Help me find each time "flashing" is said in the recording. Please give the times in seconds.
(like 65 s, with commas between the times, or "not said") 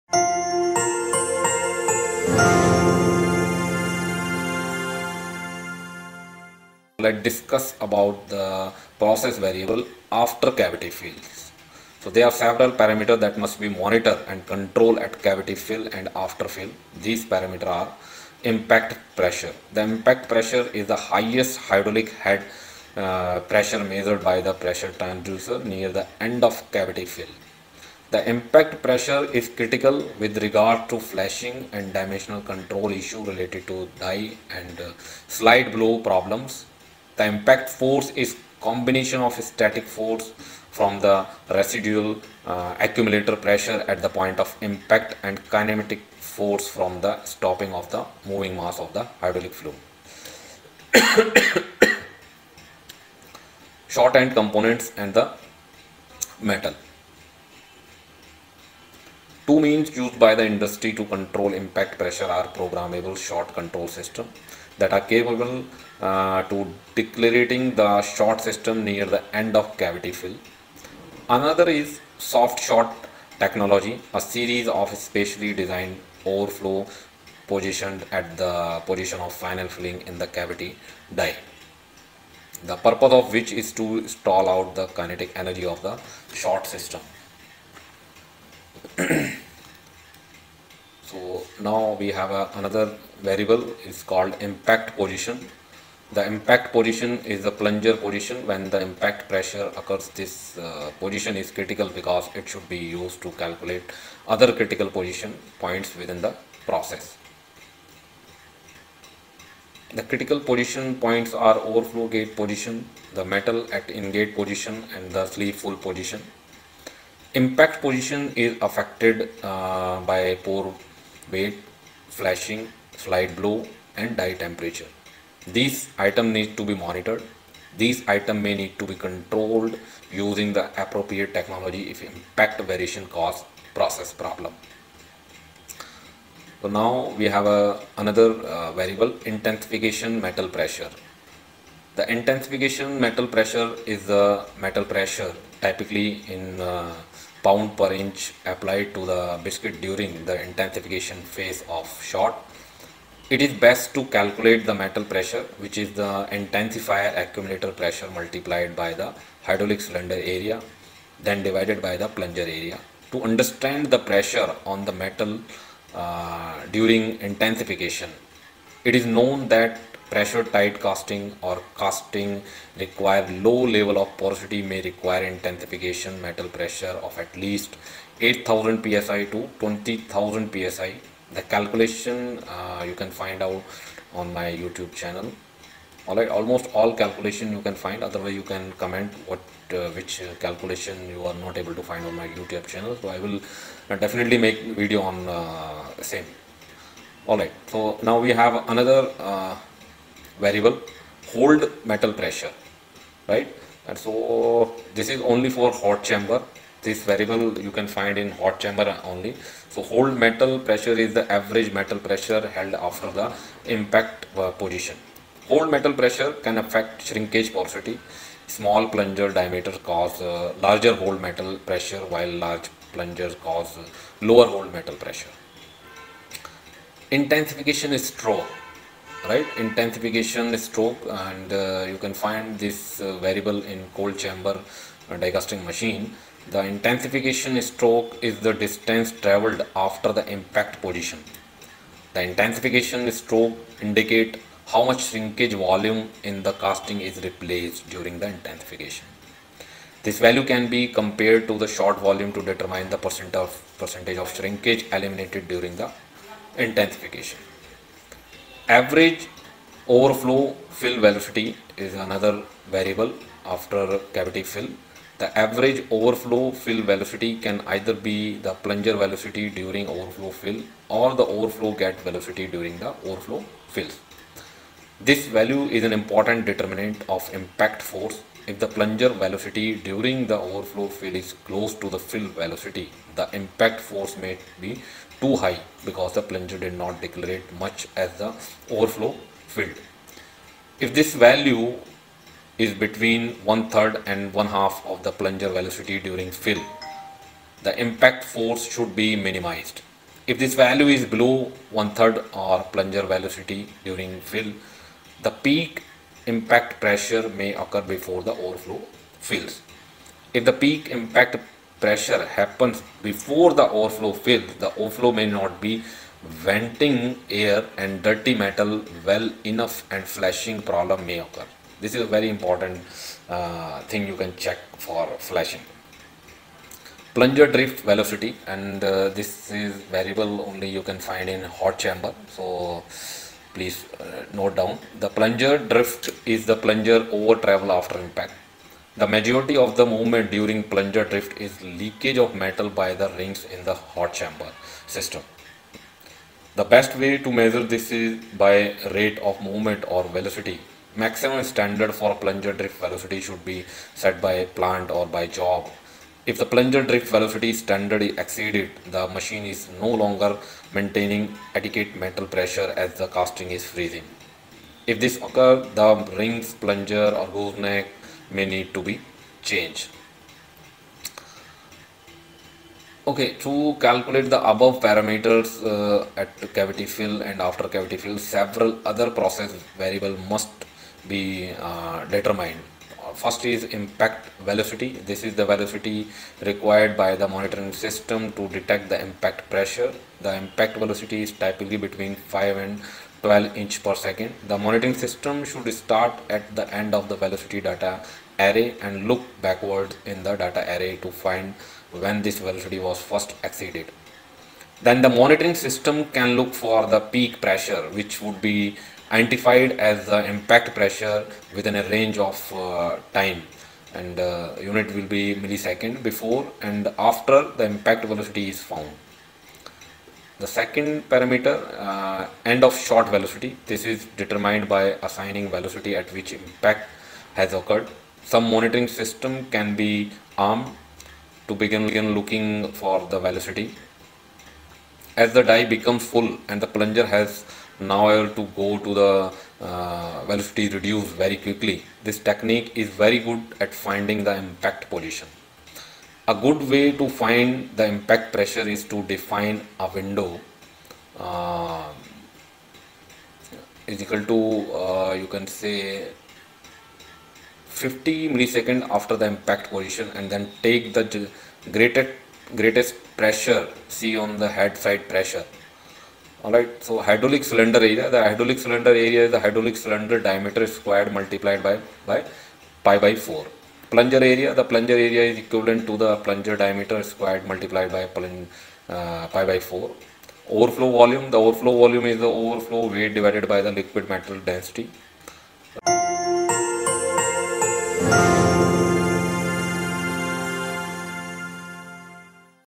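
30 s, 122 s, 320 s, 325 s.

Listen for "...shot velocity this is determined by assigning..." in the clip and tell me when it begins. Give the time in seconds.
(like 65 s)
422 s.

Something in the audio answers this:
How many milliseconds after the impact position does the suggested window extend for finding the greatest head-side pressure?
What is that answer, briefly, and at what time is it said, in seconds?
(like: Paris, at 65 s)
50, at 457 s.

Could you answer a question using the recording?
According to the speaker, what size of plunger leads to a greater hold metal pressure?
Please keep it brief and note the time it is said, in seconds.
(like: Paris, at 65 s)
small plunger diameter, at 218 s.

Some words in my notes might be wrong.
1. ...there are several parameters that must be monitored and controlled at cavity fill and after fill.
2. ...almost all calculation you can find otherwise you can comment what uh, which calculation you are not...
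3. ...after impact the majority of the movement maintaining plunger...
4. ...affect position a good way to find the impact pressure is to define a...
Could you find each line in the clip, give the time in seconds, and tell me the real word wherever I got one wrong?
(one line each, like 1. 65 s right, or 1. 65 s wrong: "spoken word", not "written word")
1. 12 s right
2. 186 s right
3. 337 s wrong: "during", not "maintaining"
4. 444 s wrong: "impact", not "affect".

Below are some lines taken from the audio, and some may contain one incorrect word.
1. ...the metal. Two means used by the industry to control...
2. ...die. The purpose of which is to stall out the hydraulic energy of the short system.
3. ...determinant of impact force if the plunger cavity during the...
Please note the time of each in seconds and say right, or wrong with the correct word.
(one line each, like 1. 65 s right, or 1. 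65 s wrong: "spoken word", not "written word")
1. 55 s right
2. 81 s wrong: "kinetic", not "hydraulic"
3. 276 s wrong: "velocity", not "cavity".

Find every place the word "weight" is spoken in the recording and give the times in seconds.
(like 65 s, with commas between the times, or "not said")
121 s, 482 s.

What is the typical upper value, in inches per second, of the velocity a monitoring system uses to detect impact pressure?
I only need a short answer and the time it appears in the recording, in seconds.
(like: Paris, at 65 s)
12, at 393 s.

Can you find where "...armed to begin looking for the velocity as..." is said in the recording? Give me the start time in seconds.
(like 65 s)
430 s.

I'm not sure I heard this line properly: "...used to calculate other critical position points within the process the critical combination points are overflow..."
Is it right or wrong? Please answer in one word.
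wrong.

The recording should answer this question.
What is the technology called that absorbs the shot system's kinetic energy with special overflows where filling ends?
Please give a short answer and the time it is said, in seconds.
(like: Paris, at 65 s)
soft shot technology, at 72 s.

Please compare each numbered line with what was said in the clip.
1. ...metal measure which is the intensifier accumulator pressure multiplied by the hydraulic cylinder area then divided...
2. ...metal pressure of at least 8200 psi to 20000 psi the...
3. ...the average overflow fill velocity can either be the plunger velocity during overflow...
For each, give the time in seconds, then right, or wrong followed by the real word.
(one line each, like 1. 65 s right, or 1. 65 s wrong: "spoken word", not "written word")
1. 154 s wrong: "pressure", not "measure"
2. 176 s wrong: "8000", not "8200"
3. 265 s right.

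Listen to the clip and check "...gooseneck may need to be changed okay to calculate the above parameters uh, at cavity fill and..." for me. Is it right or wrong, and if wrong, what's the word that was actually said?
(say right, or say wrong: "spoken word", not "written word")
right.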